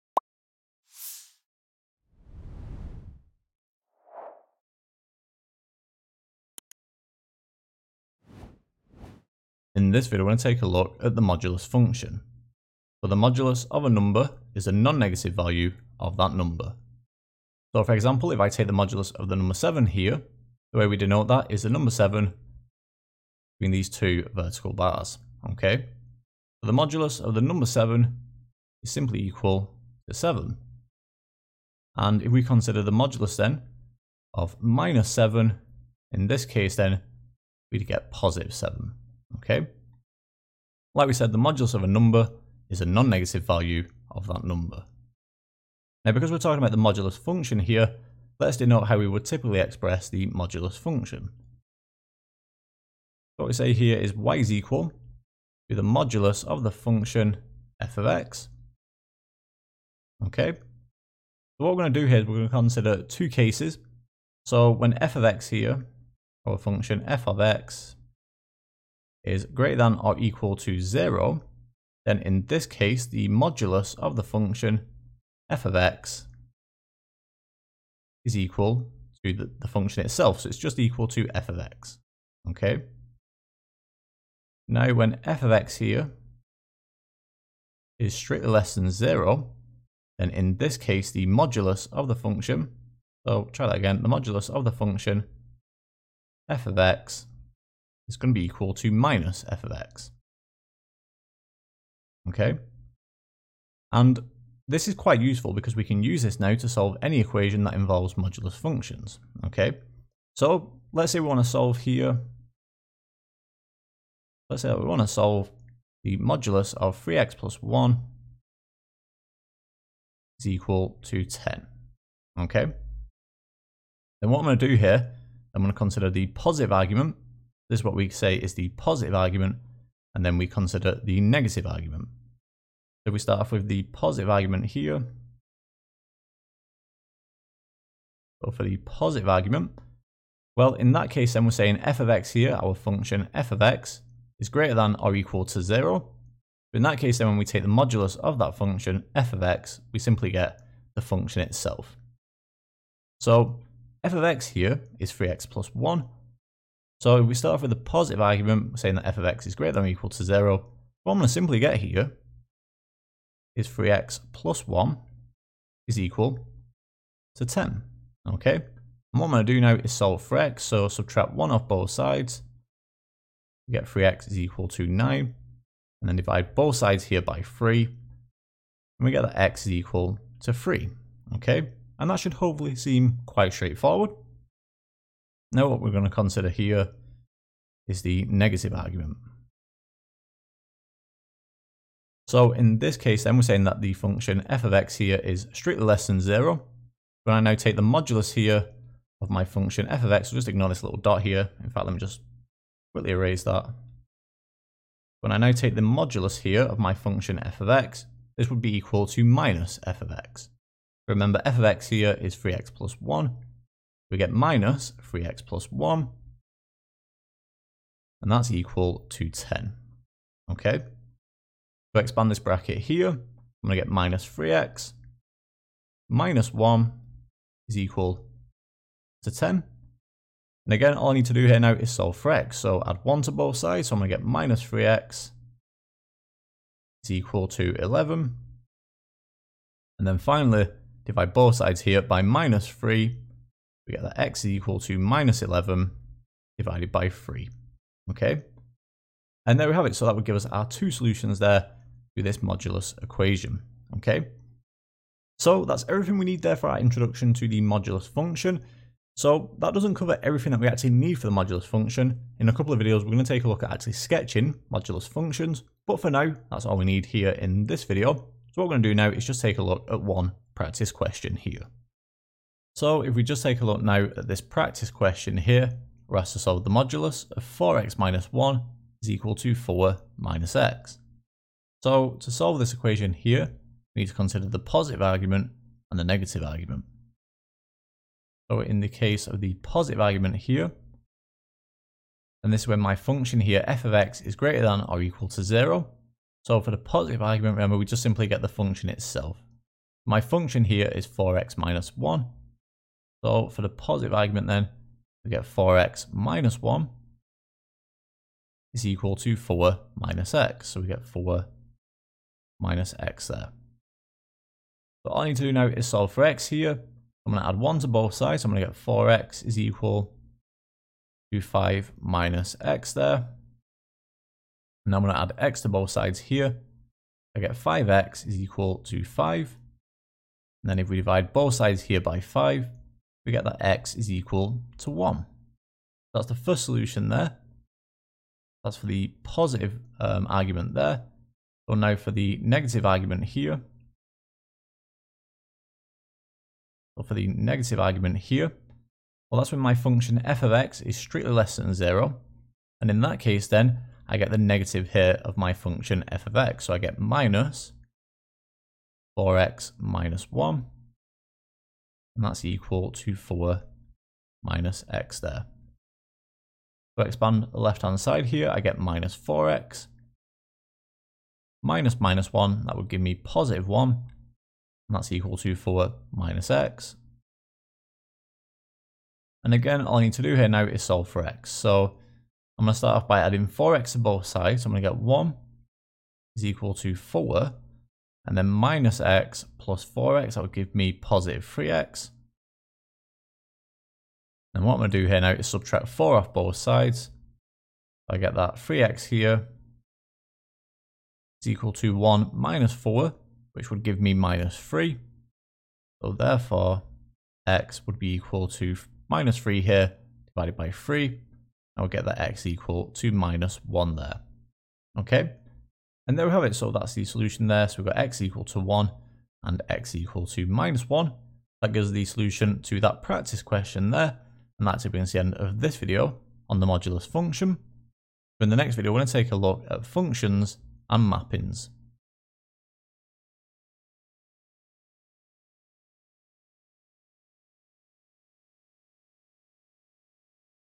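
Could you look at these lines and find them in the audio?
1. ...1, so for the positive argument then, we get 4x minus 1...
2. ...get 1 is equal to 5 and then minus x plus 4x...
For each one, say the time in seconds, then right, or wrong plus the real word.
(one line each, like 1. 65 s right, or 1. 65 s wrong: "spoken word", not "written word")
1. 301 s right
2. 384 s wrong: "4", not "5".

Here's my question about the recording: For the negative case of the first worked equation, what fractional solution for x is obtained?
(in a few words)
-11/3.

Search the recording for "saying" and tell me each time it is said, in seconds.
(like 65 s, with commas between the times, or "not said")
141 s, 158 s, 193 s.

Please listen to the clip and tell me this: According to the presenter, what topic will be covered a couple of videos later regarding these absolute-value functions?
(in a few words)
Sketching modulus functions.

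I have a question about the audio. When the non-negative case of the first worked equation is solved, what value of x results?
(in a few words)
3.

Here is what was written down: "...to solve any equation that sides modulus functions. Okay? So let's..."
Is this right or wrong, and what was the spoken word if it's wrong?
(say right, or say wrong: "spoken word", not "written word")
wrong: "involves", not "sides".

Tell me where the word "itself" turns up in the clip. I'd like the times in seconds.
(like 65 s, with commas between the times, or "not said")
80 s, 151 s, 298 s.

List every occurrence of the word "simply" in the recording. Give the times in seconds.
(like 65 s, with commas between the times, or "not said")
28 s, 149 s, 161 s, 298 s.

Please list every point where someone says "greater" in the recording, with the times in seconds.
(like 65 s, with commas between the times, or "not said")
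69 s, 144 s, 159 s, 294 s.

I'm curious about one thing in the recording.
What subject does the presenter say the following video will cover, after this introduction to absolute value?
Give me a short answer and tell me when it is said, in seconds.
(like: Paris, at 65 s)
Functions and mappings, at 429 s.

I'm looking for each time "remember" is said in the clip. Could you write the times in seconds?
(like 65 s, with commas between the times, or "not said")
211 s, 297 s.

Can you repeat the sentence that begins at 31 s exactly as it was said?
And if we consider the modulus then of minus 7, in this case then, we'd get positive 7.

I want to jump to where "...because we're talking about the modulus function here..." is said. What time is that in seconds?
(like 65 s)
46 s.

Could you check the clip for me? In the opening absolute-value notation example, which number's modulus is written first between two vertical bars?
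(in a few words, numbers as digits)
7.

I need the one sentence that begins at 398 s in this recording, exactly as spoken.
I get that 3x here is equal to 1 minus 4, which would give me minus 3.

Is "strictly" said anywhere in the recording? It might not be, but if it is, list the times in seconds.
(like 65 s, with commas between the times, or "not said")
88 s, 195 s, 350 s.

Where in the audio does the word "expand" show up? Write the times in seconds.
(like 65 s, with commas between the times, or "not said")
221 s, 367 s.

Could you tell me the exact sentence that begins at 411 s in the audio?
I'll get that x equal to minus 1 there.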